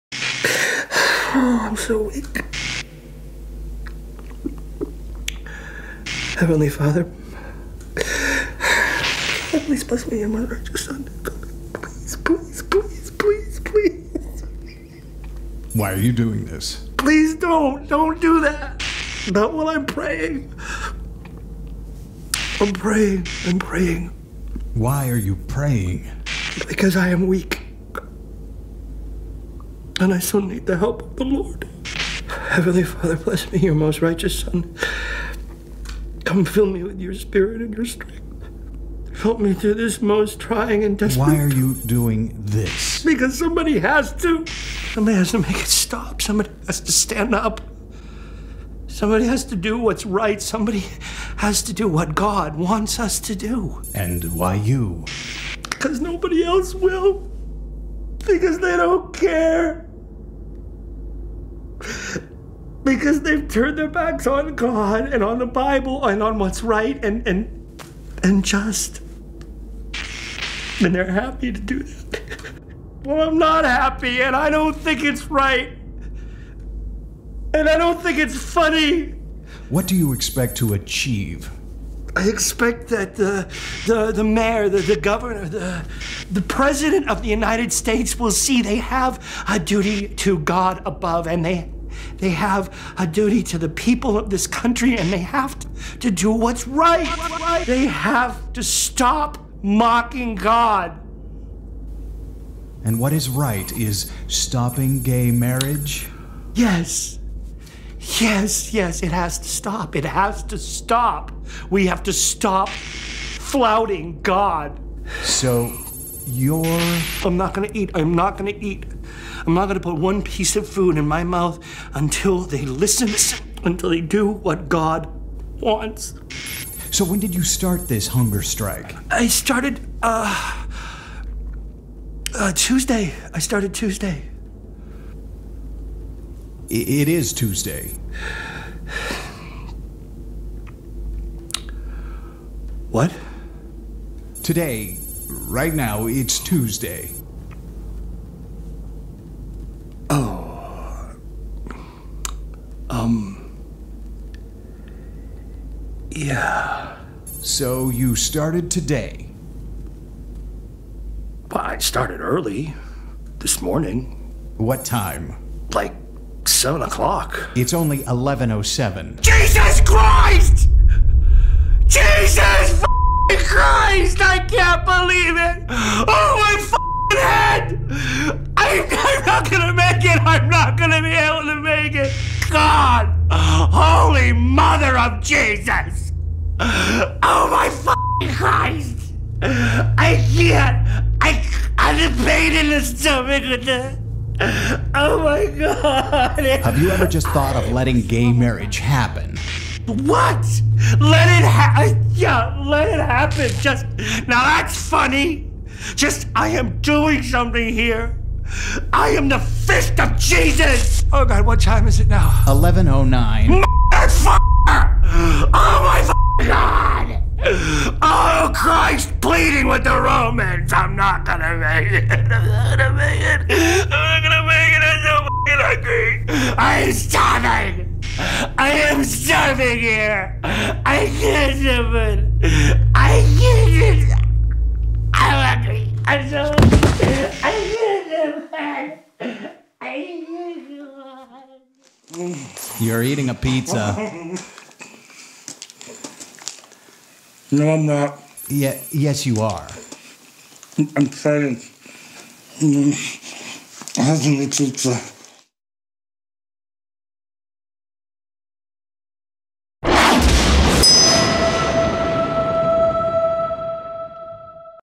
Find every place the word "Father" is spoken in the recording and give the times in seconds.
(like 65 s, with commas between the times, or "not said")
6 s, 32 s.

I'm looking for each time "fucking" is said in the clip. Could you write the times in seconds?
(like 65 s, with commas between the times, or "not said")
187 s, 225 s.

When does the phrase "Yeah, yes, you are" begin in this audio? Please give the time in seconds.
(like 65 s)
248 s.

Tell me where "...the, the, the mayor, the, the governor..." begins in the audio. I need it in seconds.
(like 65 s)
83 s.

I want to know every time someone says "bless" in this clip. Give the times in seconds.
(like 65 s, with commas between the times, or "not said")
9 s, 33 s.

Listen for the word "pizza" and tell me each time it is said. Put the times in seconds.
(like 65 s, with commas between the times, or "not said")
243 s, 254 s.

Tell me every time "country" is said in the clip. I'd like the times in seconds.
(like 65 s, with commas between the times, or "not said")
94 s.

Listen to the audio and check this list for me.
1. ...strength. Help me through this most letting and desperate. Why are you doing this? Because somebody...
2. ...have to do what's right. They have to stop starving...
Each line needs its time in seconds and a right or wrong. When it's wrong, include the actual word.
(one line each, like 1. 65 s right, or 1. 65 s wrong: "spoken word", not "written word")
1. 37 s wrong: "trying", not "letting"
2. 95 s wrong: "mocking", not "starving".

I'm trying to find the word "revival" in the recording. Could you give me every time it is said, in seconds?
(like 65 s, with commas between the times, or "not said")
not said.